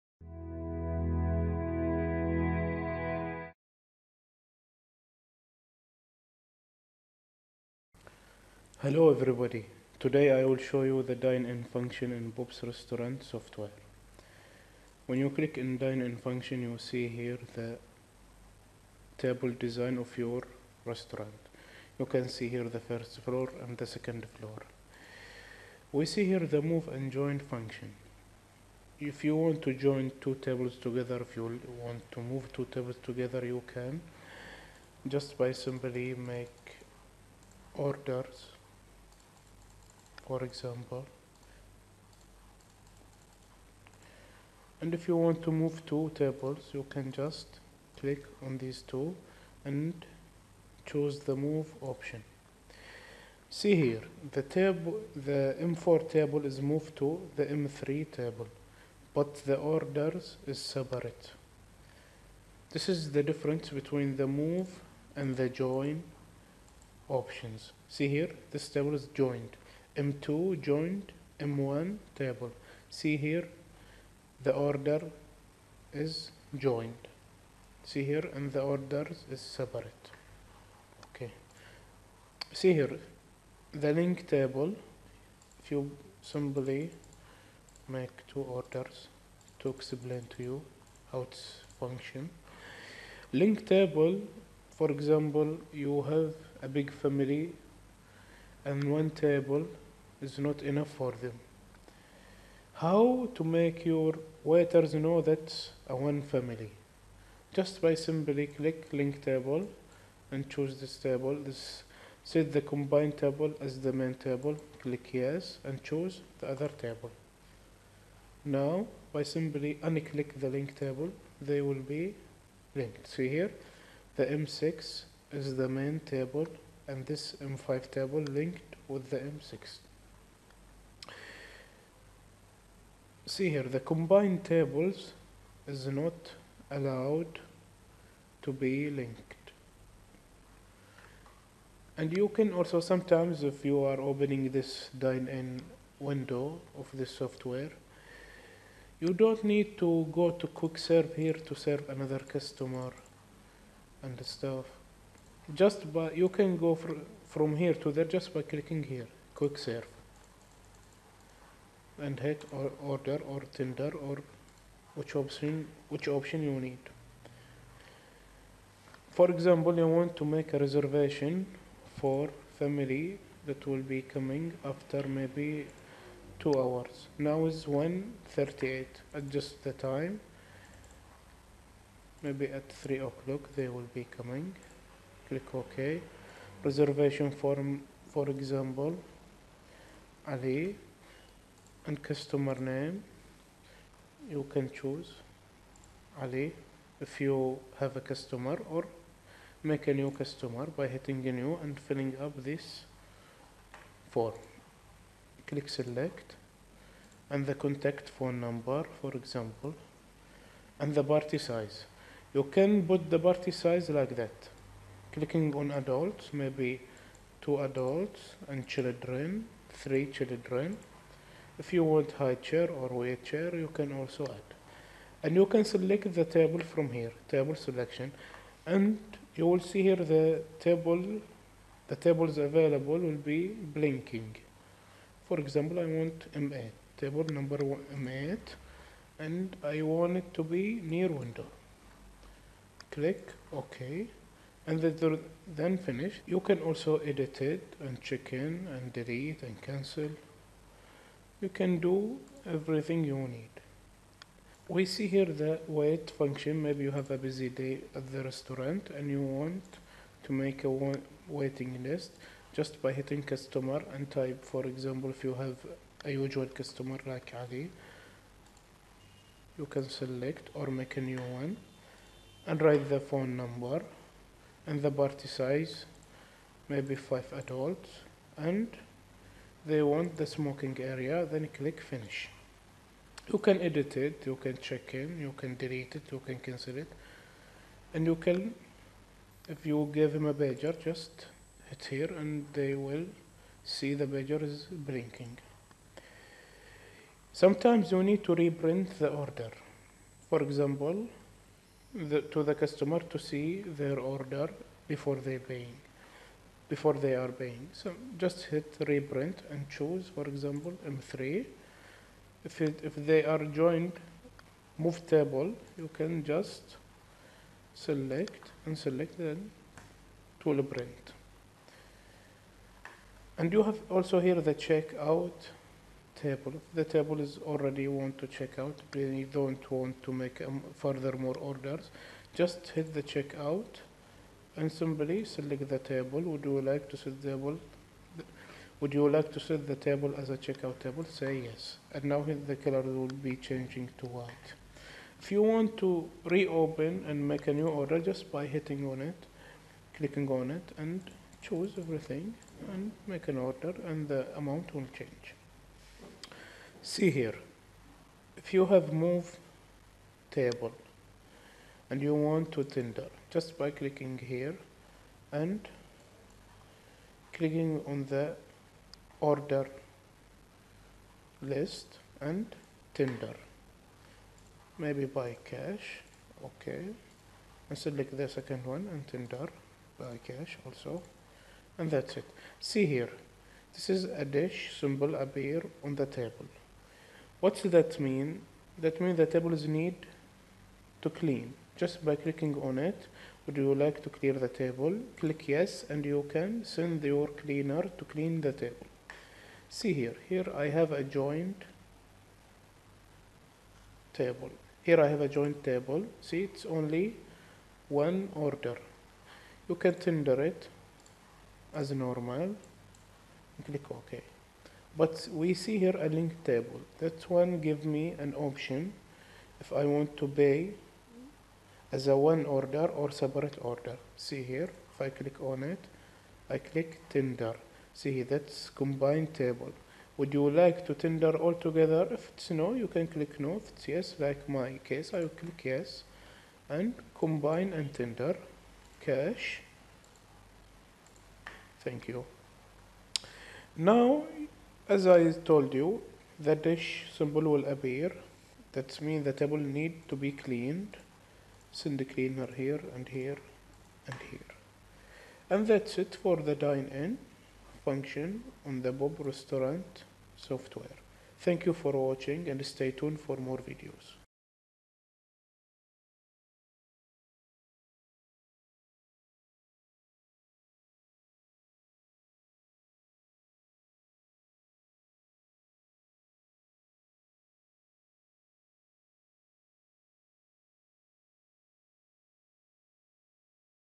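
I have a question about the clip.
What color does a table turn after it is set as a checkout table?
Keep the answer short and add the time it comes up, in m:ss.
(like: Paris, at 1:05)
white, at 5:44.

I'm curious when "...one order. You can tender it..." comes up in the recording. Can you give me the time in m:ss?
6:47.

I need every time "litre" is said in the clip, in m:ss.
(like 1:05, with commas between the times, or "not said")
not said.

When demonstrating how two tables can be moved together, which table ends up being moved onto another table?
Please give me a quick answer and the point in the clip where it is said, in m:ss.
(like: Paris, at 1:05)
M4, at 0:55.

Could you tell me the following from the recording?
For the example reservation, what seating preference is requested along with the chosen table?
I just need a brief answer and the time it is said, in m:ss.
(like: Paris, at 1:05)
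near window, at 4:00.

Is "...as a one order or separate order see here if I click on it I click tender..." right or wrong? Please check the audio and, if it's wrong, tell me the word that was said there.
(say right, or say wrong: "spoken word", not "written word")
right.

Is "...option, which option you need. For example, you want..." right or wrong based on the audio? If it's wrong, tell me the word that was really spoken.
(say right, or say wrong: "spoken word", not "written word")
right.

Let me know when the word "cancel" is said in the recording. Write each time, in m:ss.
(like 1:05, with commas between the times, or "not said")
4:09, 4:46.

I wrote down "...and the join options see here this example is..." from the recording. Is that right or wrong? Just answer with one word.
wrong.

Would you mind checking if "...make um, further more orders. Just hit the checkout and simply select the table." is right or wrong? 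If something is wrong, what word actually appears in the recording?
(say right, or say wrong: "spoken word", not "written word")
right.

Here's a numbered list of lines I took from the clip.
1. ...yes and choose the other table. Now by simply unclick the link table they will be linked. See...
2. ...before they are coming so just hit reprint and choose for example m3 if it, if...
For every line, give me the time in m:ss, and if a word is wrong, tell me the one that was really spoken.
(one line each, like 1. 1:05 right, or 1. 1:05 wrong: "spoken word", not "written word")
1. 1:55 right
2. 5:06 wrong: "paying", not "coming".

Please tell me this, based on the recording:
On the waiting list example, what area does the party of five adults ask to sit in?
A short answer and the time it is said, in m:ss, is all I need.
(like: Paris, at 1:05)
smoking area, at 4:40.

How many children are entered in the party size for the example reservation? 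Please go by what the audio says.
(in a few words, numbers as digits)
3.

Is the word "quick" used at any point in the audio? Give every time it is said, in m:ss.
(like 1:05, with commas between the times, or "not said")
2:30, 2:39.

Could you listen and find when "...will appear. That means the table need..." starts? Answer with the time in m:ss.
7:27.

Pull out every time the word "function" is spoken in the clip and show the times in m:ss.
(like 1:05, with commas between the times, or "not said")
0:11, 0:16, 0:27, 1:31, 4:16, 7:37.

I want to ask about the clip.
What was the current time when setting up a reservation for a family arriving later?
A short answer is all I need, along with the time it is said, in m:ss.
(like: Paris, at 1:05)
1:38, at 2:57.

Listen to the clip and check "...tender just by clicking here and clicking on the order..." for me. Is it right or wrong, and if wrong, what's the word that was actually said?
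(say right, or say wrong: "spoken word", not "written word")
right.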